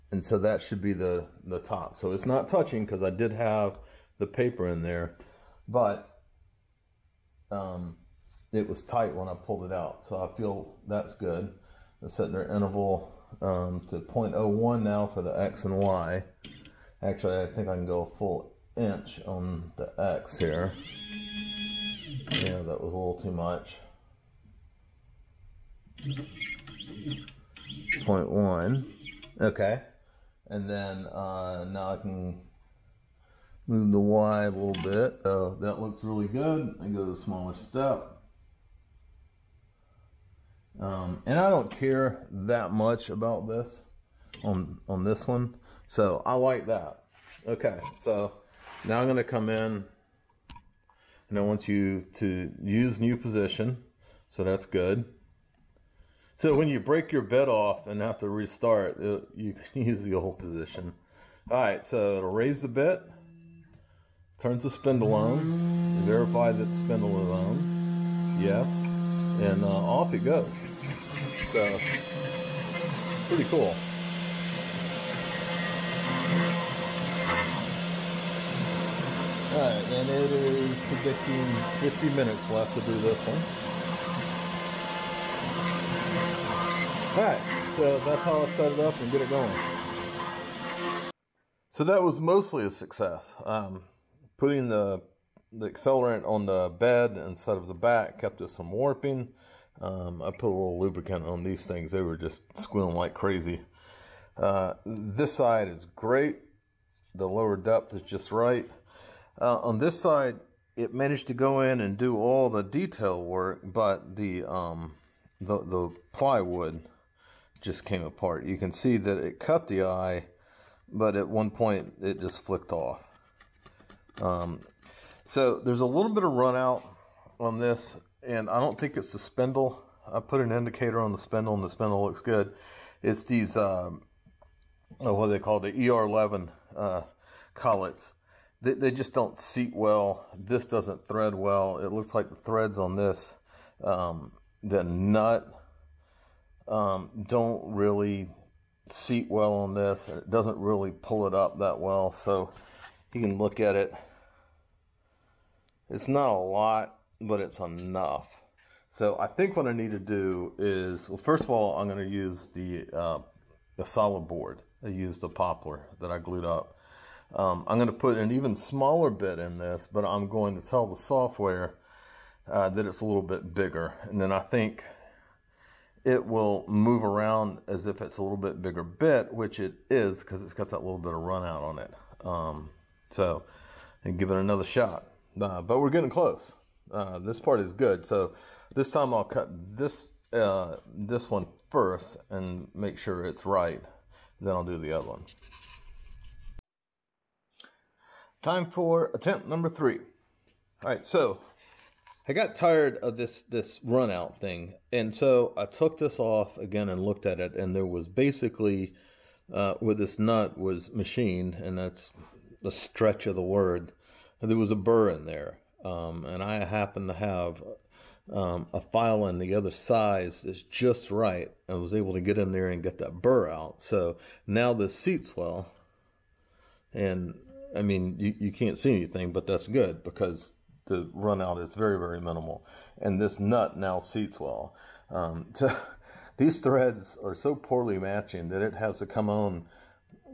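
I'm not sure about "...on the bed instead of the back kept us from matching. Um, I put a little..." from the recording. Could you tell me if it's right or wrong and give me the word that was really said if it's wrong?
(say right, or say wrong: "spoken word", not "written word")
wrong: "warping", not "matching".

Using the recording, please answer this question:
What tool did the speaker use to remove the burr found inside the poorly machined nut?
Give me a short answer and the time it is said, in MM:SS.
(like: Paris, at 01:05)
a file, at 03:38.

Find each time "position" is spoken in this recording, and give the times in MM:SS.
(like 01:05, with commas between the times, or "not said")
00:53, 01:00.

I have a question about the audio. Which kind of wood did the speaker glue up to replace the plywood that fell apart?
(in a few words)
poplar.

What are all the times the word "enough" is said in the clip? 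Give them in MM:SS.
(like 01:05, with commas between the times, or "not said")
02:37.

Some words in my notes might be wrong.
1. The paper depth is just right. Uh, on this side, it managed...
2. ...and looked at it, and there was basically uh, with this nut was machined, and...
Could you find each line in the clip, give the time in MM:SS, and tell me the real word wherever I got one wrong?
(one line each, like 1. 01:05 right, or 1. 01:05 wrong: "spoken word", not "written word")
1. 01:47 wrong: "lower", not "paper"
2. 03:26 right.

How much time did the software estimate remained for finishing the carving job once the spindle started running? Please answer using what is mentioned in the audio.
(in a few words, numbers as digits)
50 minutes.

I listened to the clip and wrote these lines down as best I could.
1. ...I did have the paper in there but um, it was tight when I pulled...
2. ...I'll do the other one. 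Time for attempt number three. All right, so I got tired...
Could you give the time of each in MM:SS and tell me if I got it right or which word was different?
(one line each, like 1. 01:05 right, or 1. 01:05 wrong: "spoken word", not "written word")
1. 00:03 right
2. 03:14 right.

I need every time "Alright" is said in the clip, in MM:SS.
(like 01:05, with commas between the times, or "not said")
01:19, 01:27.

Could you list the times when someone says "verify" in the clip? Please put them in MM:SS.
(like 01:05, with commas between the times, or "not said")
01:06.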